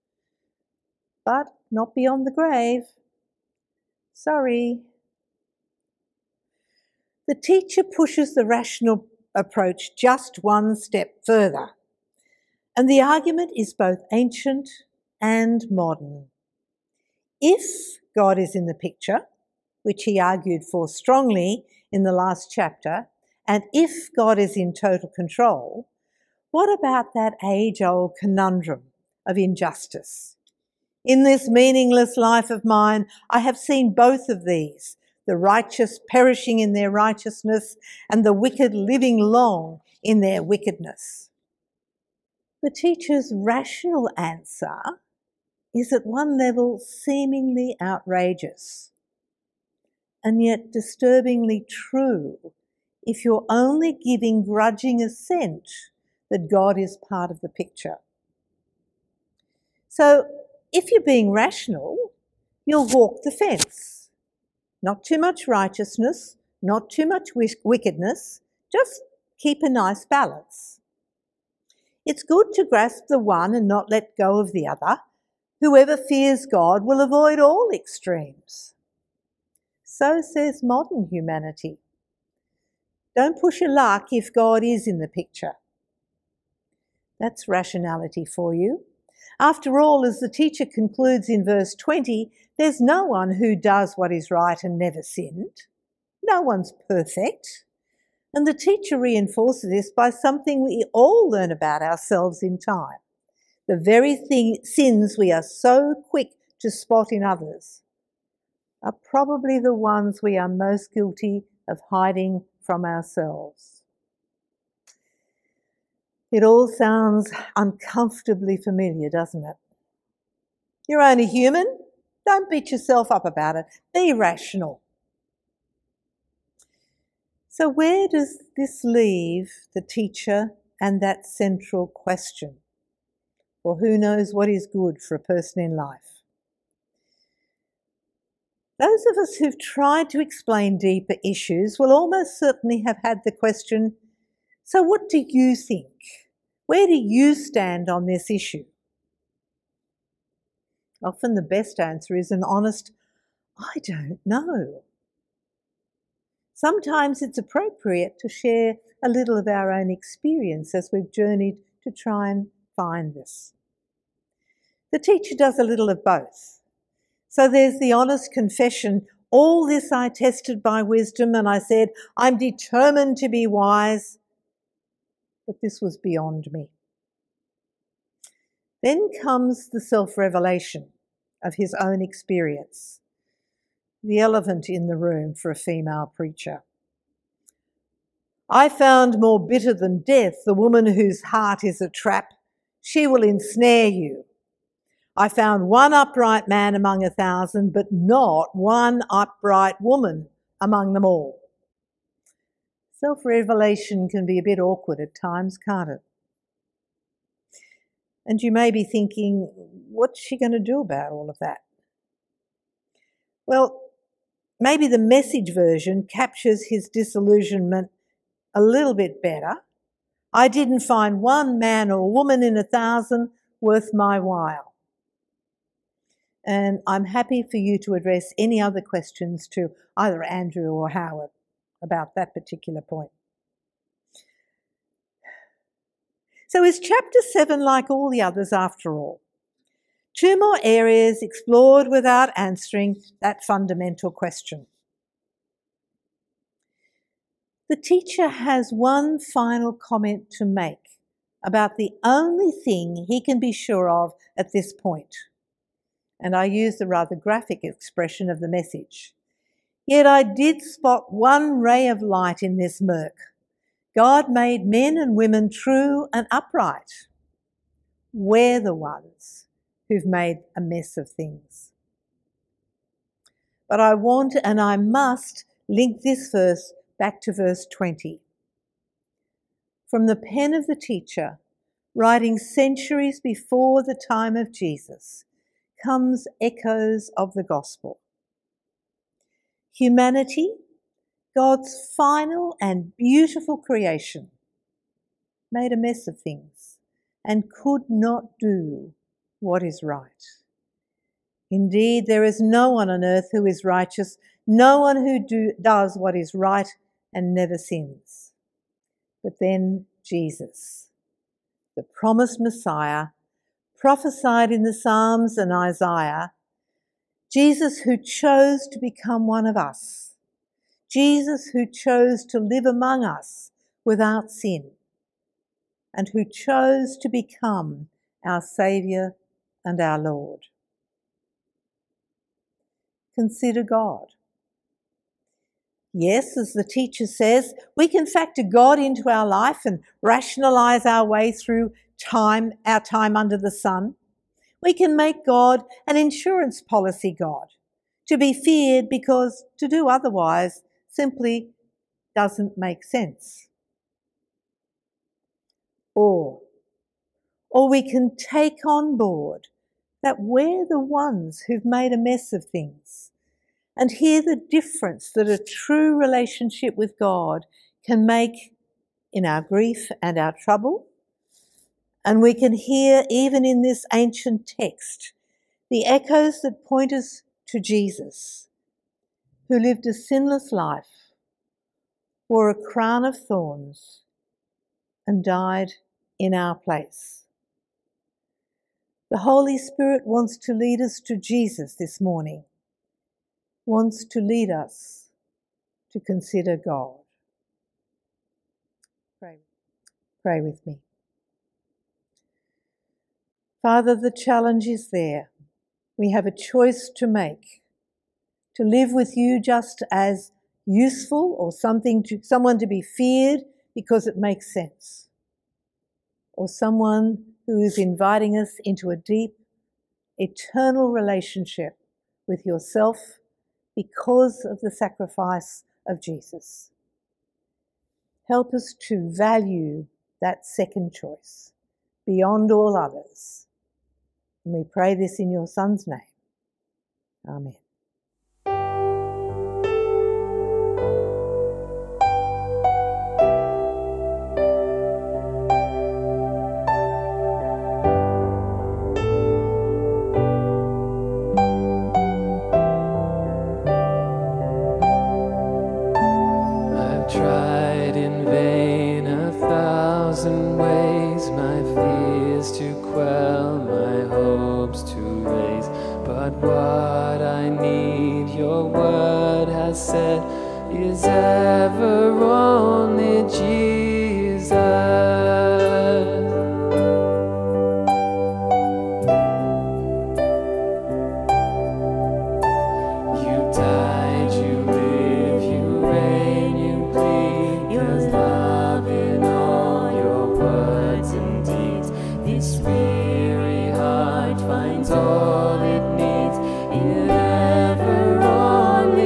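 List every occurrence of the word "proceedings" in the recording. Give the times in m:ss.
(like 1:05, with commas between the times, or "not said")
not said.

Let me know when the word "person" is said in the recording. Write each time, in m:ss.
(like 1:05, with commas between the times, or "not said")
2:15.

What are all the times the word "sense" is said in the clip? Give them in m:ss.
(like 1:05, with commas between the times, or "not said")
5:52, 6:54.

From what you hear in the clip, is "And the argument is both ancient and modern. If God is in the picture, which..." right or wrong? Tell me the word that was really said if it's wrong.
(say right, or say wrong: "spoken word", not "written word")
right.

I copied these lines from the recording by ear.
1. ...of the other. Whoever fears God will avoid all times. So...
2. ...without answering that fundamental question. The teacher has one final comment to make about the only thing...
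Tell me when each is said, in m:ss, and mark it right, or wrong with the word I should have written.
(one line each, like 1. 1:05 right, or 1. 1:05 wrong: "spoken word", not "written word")
1. 1:14 wrong: "extremes", not "times"
2. 4:01 right.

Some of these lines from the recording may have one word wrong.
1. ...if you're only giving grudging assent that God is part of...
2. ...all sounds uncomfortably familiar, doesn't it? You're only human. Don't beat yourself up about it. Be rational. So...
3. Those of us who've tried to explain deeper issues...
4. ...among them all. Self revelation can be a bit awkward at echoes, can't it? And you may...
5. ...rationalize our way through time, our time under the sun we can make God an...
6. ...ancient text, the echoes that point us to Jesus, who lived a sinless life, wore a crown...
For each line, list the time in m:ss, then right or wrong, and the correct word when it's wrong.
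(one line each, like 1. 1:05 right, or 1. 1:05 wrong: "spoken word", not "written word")
1. 0:53 right
2. 1:56 right
3. 2:18 right
4. 3:20 wrong: "times", not "echoes"
5. 5:40 right
6. 6:13 right.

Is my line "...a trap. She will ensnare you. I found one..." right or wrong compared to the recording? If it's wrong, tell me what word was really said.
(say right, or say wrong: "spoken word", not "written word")
right.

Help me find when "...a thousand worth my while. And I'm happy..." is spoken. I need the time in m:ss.
3:42.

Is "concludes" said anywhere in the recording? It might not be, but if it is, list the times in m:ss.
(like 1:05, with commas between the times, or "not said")
1:30.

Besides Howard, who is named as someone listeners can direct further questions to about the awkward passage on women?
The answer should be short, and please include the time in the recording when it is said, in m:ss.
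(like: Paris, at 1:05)
Andrew, at 3:50.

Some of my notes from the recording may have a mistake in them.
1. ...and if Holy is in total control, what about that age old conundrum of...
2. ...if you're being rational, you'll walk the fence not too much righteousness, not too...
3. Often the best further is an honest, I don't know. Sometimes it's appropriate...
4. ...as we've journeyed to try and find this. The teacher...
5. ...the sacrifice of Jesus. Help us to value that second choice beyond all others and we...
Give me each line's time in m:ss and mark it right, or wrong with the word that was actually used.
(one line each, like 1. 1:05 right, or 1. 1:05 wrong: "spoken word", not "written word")
1. 0:23 wrong: "God", not "Holy"
2. 1:00 right
3. 2:31 wrong: "answer", not "further"
4. 2:40 right
5. 7:04 right.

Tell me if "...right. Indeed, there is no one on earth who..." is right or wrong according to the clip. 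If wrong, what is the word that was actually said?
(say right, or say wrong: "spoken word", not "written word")
right.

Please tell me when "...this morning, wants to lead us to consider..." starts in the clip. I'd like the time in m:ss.
6:31.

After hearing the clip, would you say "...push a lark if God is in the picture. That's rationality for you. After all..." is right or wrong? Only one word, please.
right.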